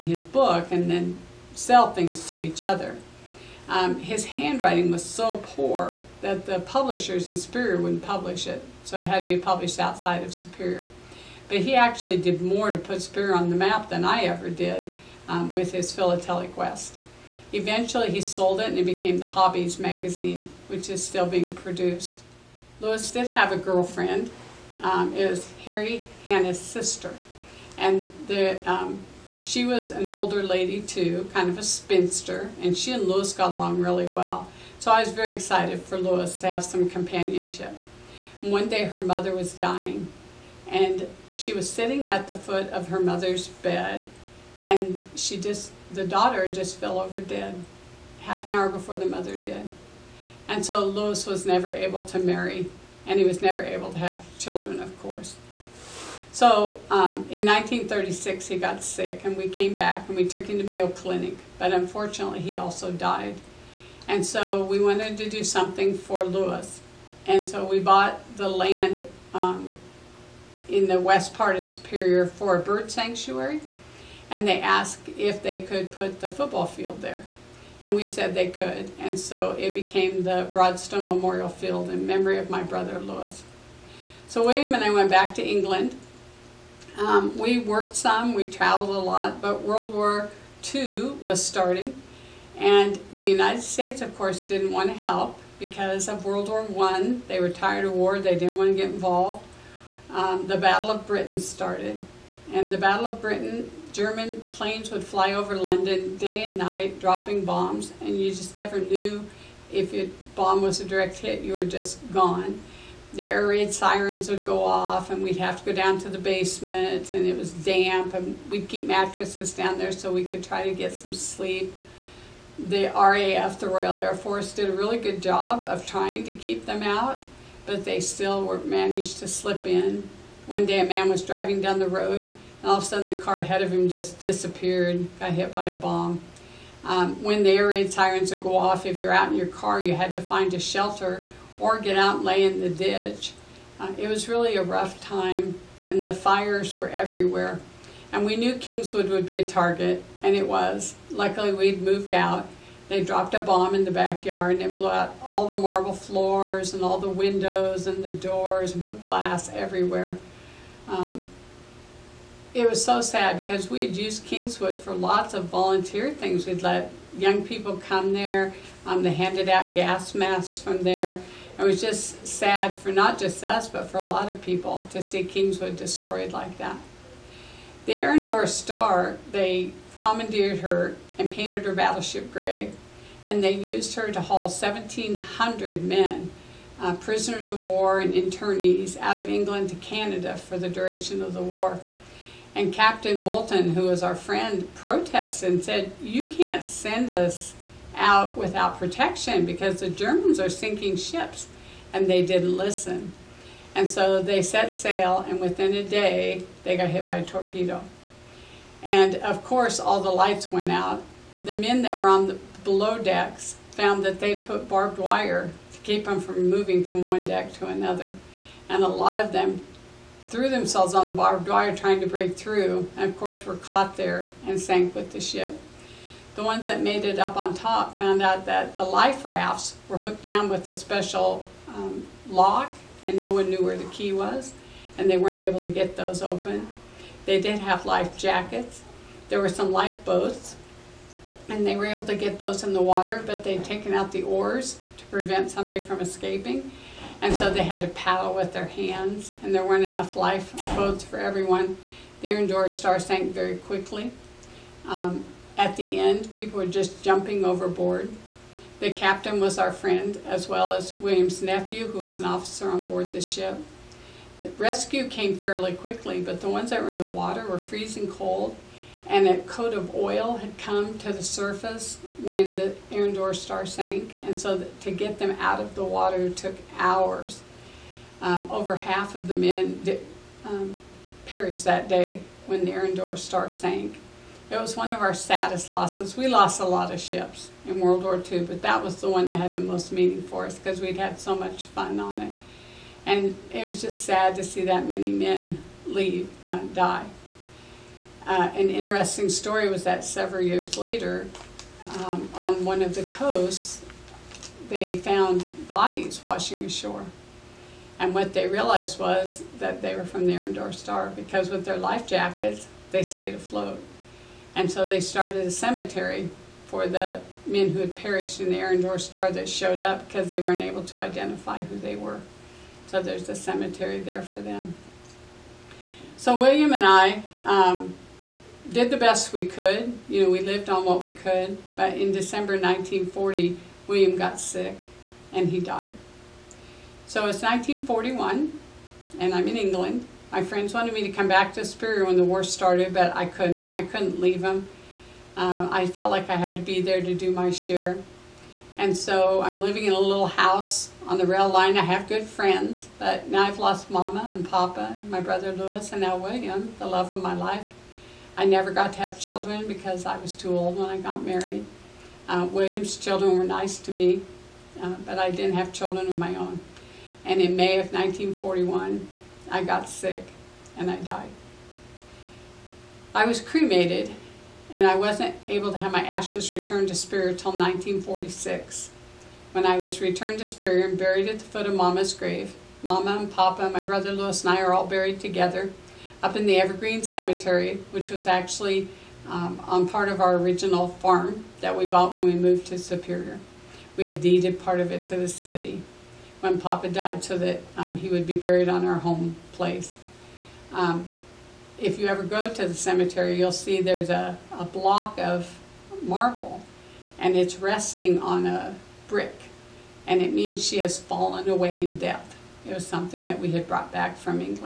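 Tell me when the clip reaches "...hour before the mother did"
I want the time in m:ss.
0:48.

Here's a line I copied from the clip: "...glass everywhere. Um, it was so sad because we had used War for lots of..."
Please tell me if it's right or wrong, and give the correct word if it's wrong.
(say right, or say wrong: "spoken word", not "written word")
wrong: "Kingswood", not "War".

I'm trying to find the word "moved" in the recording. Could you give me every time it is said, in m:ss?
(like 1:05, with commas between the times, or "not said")
2:31, 6:32.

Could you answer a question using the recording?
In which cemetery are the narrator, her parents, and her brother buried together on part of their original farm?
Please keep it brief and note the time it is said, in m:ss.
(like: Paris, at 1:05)
Evergreen Cemetery, at 6:26.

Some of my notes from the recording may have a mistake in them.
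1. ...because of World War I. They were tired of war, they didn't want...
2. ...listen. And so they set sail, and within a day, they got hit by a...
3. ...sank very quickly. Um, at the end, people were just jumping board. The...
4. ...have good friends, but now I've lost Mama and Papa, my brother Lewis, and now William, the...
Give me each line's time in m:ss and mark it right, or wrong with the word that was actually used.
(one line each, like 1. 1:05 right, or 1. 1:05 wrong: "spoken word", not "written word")
1. 1:35 right
2. 3:22 right
3. 4:12 wrong: "overboard", not "board"
4. 5:51 right.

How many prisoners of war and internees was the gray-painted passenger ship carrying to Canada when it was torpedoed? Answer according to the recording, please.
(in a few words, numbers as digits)
1,700.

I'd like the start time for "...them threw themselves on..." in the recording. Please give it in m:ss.
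3:39.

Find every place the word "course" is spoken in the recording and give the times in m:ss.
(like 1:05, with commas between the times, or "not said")
0:55, 1:34, 3:29, 3:43.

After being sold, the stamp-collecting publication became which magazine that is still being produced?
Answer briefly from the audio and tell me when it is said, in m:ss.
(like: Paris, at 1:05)
Hobbies, at 0:19.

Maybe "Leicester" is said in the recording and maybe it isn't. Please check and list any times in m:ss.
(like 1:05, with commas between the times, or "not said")
not said.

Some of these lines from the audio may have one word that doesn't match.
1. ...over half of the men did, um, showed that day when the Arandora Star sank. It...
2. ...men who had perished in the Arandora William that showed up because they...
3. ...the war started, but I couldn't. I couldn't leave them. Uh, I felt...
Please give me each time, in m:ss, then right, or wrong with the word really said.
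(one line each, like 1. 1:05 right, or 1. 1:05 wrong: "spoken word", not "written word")
1. 4:38 wrong: "perished", not "showed"
2. 5:17 wrong: "Star", not "William"
3. 5:42 right.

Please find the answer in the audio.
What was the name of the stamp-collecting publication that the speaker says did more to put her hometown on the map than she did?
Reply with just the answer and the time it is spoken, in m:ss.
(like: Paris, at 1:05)
Philatelic West, at 0:15.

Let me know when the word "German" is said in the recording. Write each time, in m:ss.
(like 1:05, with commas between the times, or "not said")
1:43, 3:19.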